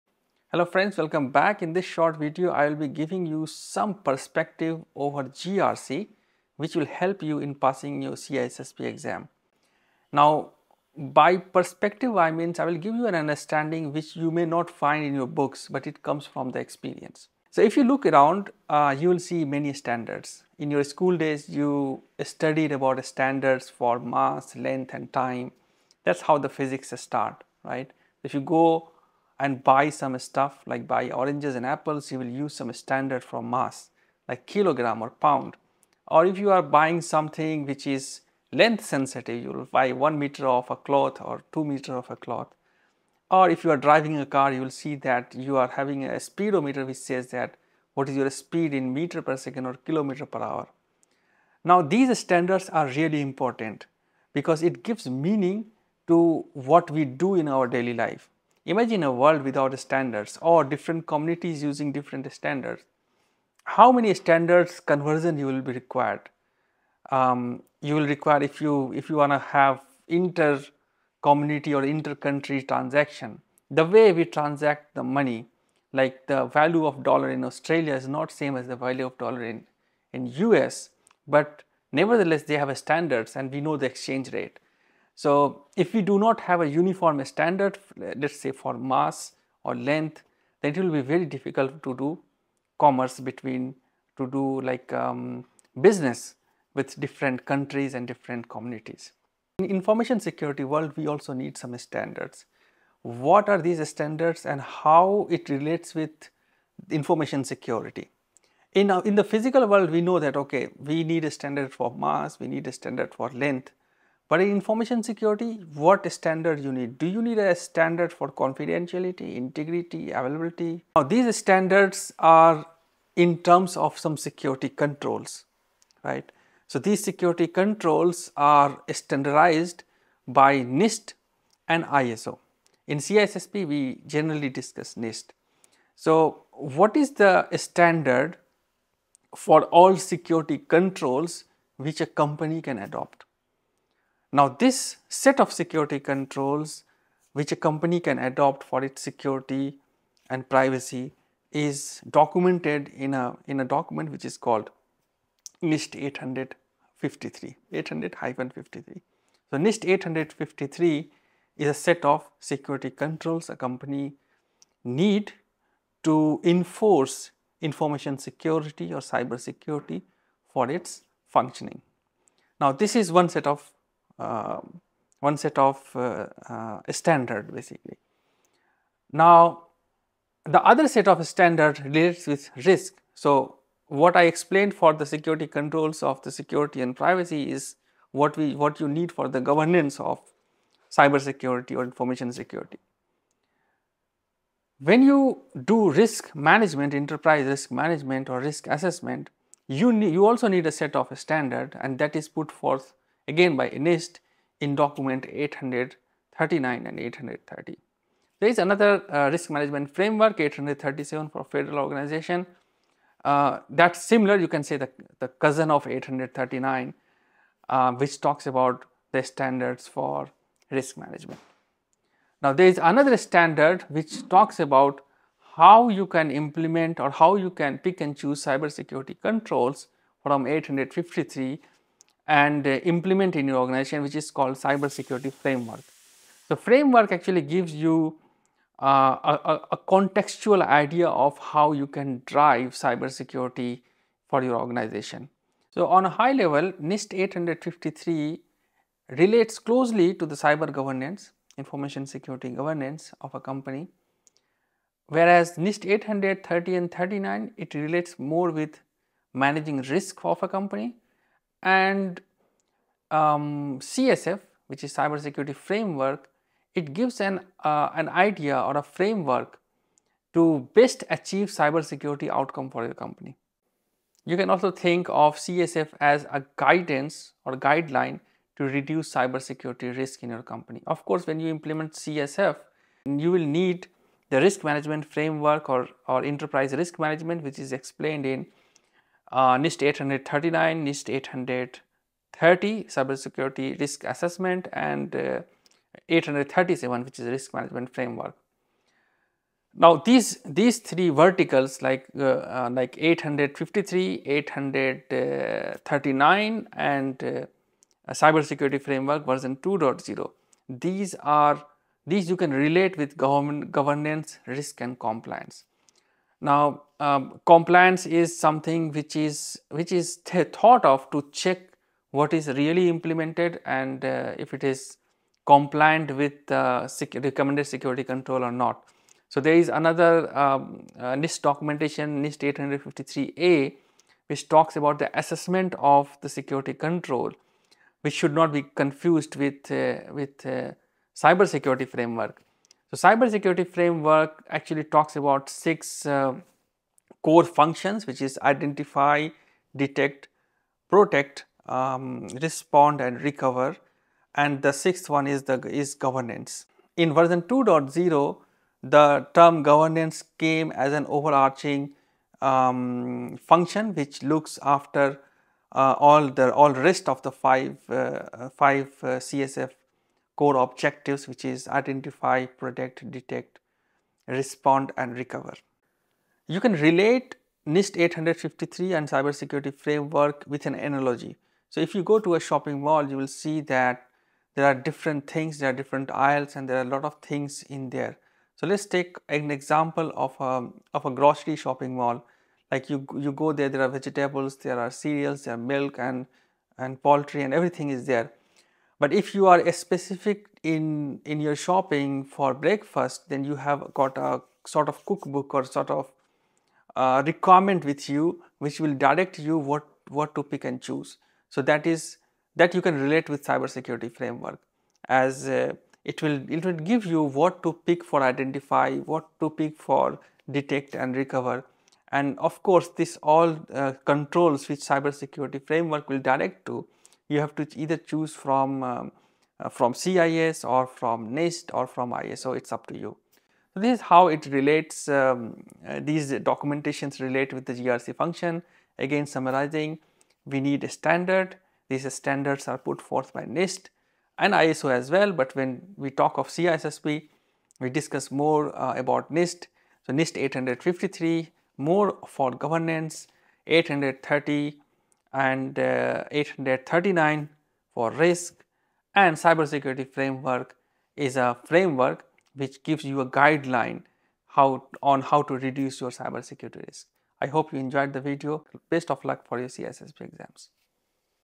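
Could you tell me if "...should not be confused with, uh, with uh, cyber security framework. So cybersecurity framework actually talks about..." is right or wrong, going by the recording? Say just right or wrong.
right.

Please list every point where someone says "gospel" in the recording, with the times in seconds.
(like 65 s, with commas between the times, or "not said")
not said.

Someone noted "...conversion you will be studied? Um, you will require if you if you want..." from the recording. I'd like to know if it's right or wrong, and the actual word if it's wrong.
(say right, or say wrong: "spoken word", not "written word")
wrong: "required", not "studied".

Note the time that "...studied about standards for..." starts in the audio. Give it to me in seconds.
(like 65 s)
22 s.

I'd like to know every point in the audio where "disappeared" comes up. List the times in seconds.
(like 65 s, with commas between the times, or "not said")
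not said.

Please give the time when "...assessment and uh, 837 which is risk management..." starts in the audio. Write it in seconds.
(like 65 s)
294 s.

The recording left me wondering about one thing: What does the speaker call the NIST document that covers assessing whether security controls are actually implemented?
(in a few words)
NIST 800-53A.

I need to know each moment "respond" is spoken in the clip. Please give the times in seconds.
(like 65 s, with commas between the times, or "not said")
352 s, 374 s.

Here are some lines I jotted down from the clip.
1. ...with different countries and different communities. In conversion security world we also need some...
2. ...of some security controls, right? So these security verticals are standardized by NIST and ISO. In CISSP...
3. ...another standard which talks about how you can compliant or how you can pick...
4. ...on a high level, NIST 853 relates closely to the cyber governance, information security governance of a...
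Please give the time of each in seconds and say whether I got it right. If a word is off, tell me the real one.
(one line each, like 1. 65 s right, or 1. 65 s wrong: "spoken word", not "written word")
1. 96 s wrong: "information", not "conversion"
2. 123 s wrong: "controls", not "verticals"
3. 222 s wrong: "implement", not "compliant"
4. 245 s right.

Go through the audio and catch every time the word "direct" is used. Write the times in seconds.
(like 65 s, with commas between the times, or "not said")
408 s, 426 s.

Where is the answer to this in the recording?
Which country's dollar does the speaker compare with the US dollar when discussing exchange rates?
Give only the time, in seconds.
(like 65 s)
77 s.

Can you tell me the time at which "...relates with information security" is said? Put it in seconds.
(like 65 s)
105 s.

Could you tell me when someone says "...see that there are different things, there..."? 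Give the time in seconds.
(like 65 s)
383 s.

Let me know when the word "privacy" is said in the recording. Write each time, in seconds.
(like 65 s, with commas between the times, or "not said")
150 s, 186 s.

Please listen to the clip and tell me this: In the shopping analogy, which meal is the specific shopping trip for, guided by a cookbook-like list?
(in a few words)
breakfast.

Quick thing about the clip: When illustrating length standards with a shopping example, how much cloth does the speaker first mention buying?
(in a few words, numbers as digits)
1 meter.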